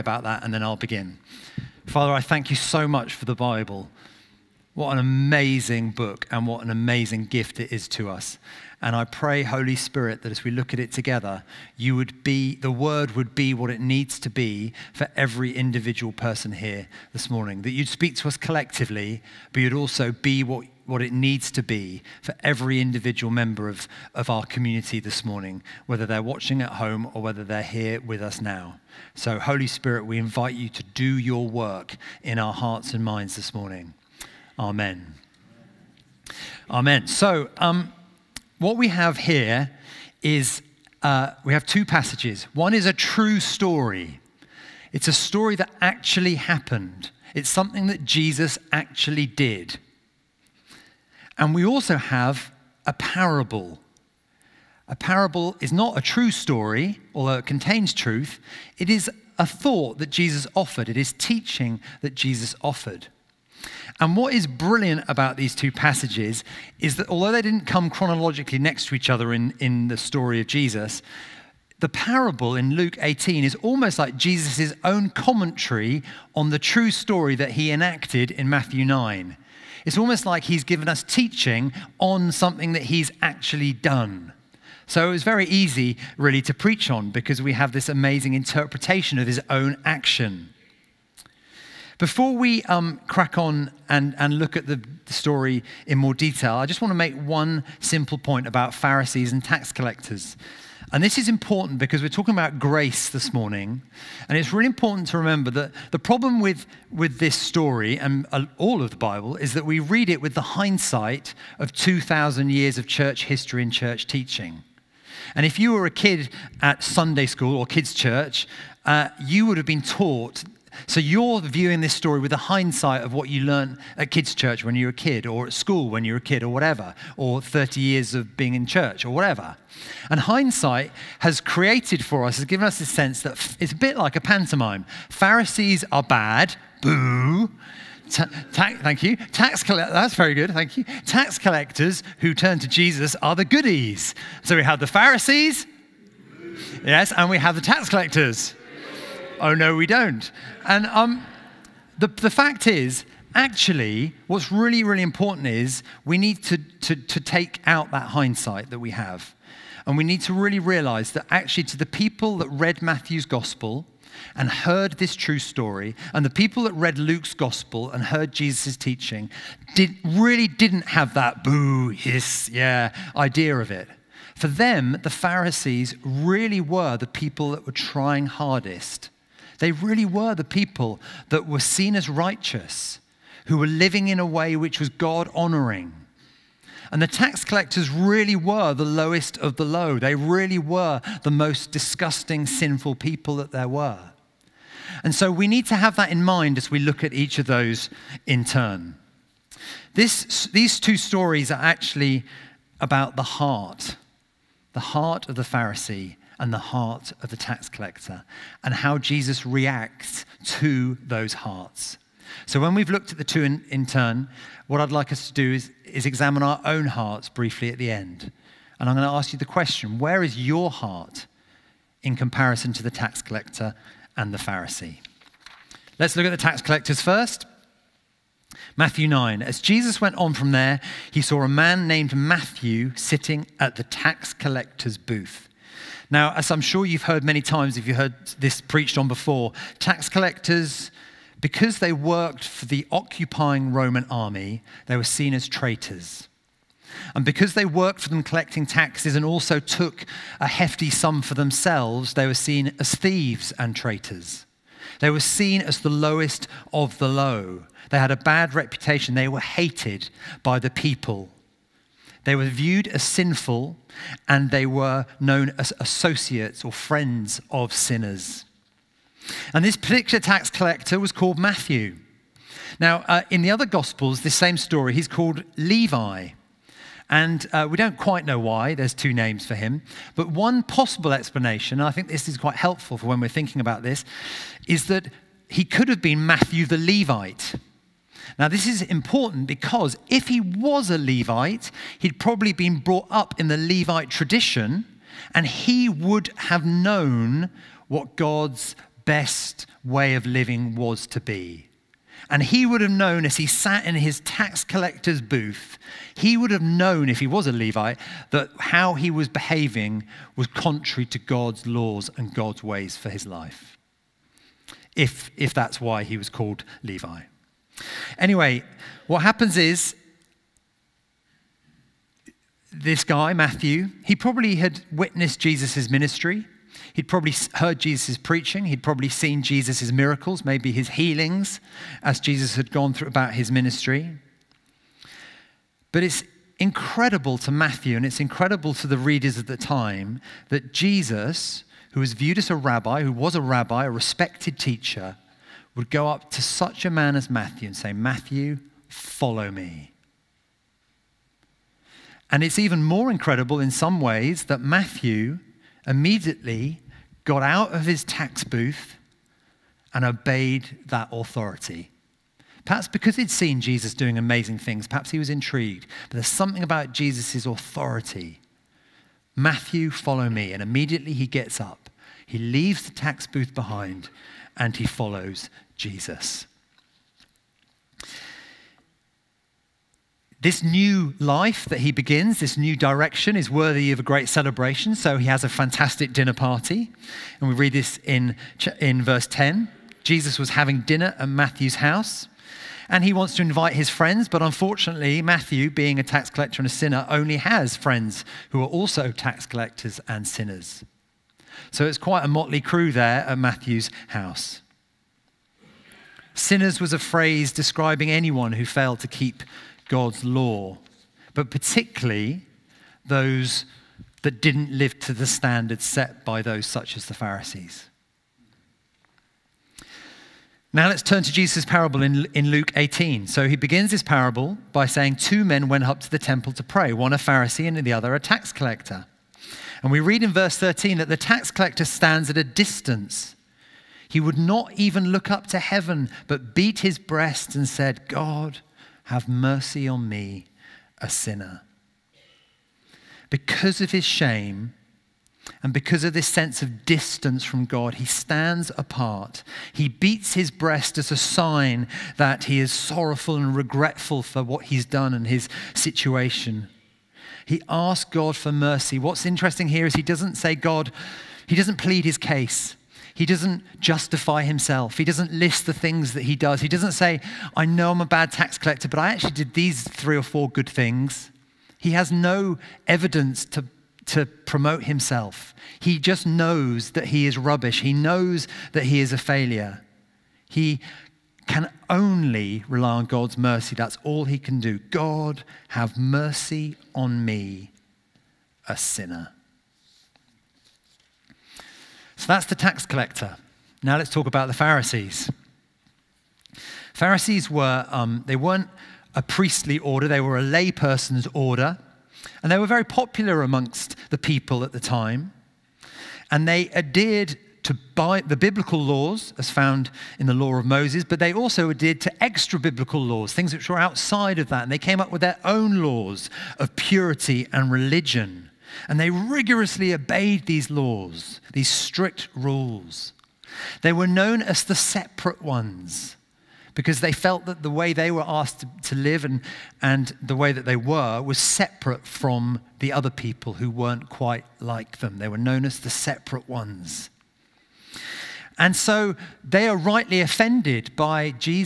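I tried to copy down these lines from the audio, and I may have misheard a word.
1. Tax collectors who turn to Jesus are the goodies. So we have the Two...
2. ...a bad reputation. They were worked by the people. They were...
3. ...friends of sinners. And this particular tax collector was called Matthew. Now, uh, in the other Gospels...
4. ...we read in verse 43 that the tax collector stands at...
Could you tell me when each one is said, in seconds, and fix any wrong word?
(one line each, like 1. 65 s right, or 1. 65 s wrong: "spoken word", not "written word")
1. 141 s wrong: "Pharisees", not "Two"
2. 258 s wrong: "hated", not "worked"
3. 266 s right
4. 429 s wrong: "13", not "43".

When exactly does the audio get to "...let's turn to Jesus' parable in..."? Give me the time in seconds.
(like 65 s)
420 s.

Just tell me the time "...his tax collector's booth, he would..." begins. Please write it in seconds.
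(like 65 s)
303 s.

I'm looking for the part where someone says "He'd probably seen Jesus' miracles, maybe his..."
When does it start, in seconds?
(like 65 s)
328 s.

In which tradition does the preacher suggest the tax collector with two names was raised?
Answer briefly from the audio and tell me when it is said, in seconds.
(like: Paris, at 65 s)
Levite tradition, at 293 s.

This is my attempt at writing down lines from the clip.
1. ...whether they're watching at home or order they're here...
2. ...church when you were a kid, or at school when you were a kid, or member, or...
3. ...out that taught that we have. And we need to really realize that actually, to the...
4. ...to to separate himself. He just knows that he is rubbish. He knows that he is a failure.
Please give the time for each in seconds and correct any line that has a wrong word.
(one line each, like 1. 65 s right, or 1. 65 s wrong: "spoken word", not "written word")
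1. 25 s wrong: "whether", not "order"
2. 124 s wrong: "whatever", not "member"
3. 157 s wrong: "hindsight", not "taught"
4. 473 s wrong: "promote", not "separate".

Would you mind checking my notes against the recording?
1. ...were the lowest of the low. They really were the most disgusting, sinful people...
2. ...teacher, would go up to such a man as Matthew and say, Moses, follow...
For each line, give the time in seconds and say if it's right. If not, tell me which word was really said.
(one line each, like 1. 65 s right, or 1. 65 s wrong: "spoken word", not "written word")
1. 188 s right
2. 344 s wrong: "Matthew", not "Moses".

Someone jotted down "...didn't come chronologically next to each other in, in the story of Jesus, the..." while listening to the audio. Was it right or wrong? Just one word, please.
right.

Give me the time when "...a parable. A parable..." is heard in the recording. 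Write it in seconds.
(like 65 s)
52 s.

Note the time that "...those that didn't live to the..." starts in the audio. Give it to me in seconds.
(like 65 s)
413 s.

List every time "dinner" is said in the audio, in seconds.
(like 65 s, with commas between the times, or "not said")
386 s, 390 s.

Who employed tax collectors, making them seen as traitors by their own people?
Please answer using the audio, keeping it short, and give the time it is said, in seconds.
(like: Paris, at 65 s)
Roman army, at 243 s.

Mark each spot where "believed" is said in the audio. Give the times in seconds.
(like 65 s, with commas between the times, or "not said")
not said.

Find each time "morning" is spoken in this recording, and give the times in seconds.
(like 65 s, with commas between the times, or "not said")
17 s, 25 s, 33 s, 103 s.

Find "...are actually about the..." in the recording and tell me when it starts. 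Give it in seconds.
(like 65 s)
201 s.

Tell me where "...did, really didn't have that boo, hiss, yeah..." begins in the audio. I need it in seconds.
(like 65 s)
169 s.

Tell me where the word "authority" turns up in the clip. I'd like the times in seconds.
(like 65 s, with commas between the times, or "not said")
361 s, 367 s.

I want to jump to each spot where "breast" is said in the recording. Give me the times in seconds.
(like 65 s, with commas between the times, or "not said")
436 s, 450 s.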